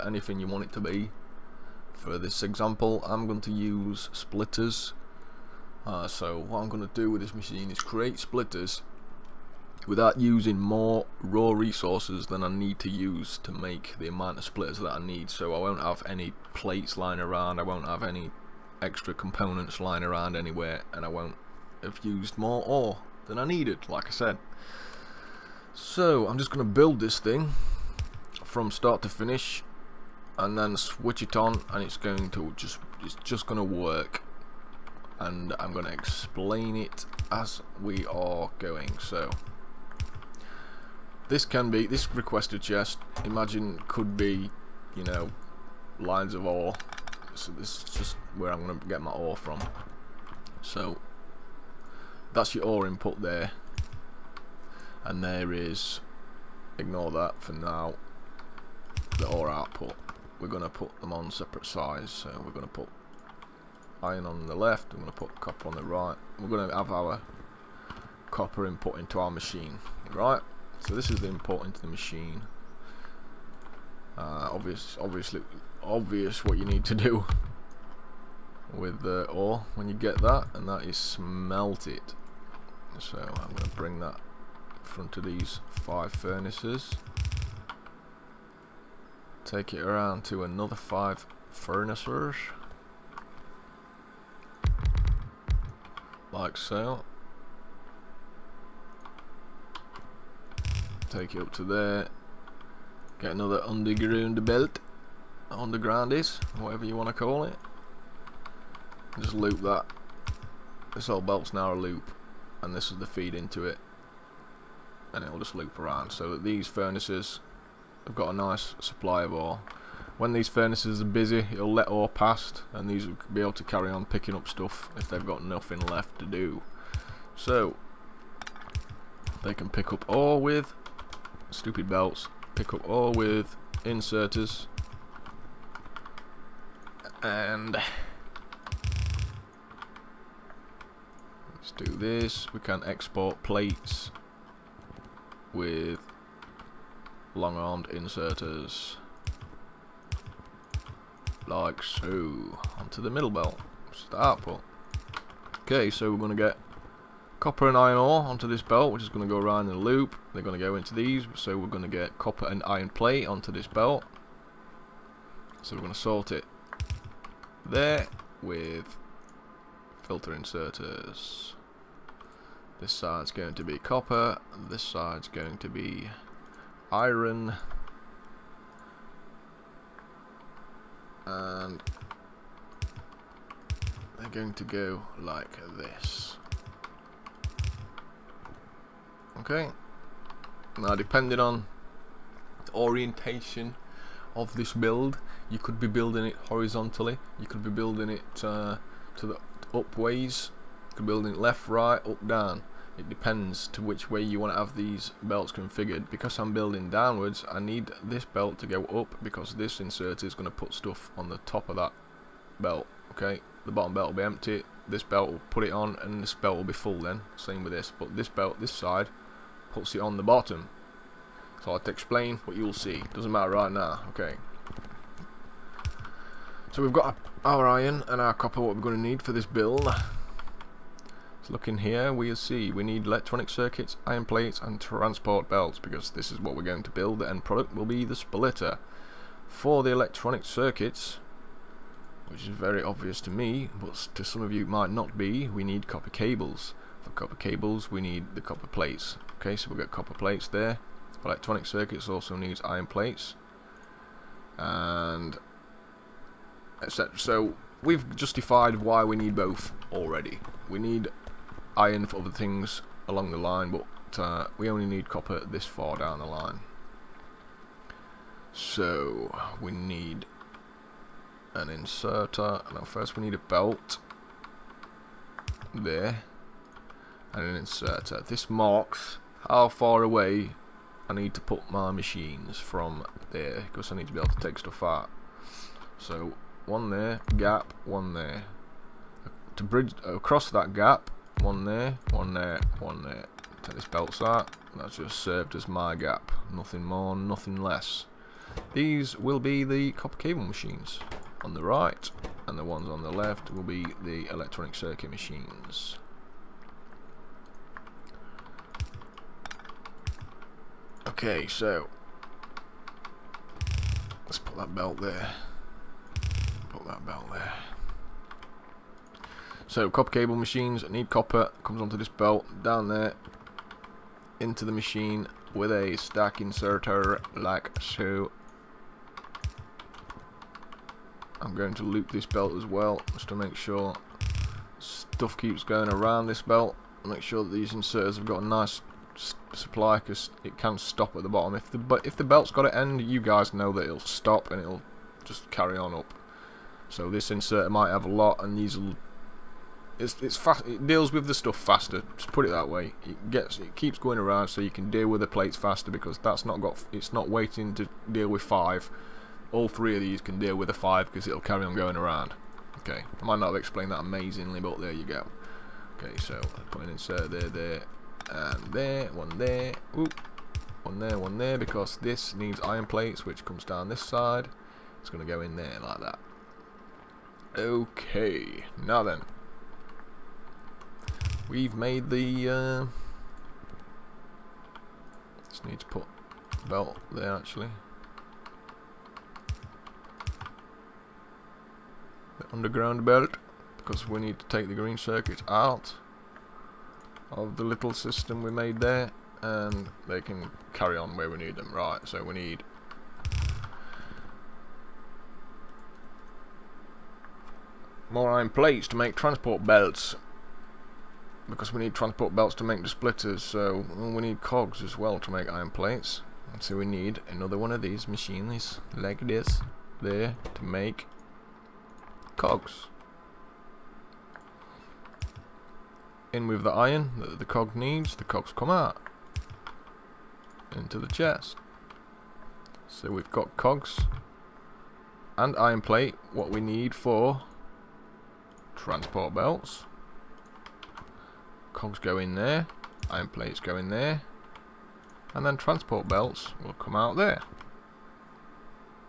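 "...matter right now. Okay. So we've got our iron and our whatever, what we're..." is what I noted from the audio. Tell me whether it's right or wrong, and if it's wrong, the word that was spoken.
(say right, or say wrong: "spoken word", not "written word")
wrong: "copper", not "whatever".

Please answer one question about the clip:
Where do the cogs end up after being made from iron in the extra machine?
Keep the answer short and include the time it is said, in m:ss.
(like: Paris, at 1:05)
Into the chest, at 7:10.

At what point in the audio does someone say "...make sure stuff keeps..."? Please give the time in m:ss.
5:33.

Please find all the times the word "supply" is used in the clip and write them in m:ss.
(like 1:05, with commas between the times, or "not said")
1:58, 5:39.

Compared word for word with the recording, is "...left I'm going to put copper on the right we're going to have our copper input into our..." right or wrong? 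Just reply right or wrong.
right.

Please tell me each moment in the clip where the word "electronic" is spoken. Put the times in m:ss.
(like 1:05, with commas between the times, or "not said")
3:53, 3:59, 4:11, 5:04.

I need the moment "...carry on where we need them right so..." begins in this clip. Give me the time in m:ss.
6:40.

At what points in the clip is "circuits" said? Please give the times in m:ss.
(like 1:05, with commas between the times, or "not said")
3:53, 4:00, 4:11, 5:04, 6:34.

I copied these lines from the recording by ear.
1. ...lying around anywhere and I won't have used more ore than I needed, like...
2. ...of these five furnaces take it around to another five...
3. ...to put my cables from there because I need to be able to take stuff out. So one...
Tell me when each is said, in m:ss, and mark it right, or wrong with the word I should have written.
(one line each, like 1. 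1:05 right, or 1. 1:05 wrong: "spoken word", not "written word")
1. 0:19 right
2. 1:25 right
3. 4:41 wrong: "machines", not "cables".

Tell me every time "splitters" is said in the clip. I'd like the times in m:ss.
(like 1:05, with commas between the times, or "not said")
0:04, 0:08, 0:14, 3:58, 6:52.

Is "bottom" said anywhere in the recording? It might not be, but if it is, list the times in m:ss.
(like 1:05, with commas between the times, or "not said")
3:33, 3:40, 5:41.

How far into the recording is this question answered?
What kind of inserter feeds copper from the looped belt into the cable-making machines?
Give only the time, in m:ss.
5:25.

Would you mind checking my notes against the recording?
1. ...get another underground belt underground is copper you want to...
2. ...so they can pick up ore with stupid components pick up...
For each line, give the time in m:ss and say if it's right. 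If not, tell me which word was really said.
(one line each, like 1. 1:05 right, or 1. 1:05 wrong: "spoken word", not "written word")
1. 1:43 wrong: "whatever", not "copper"
2. 2:07 wrong: "belts", not "components".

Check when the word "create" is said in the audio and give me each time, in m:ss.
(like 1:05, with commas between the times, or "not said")
0:07.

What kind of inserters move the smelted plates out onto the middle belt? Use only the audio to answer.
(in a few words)
Long-armed inserters.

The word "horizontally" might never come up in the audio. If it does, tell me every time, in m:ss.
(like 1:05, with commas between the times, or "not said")
3:16.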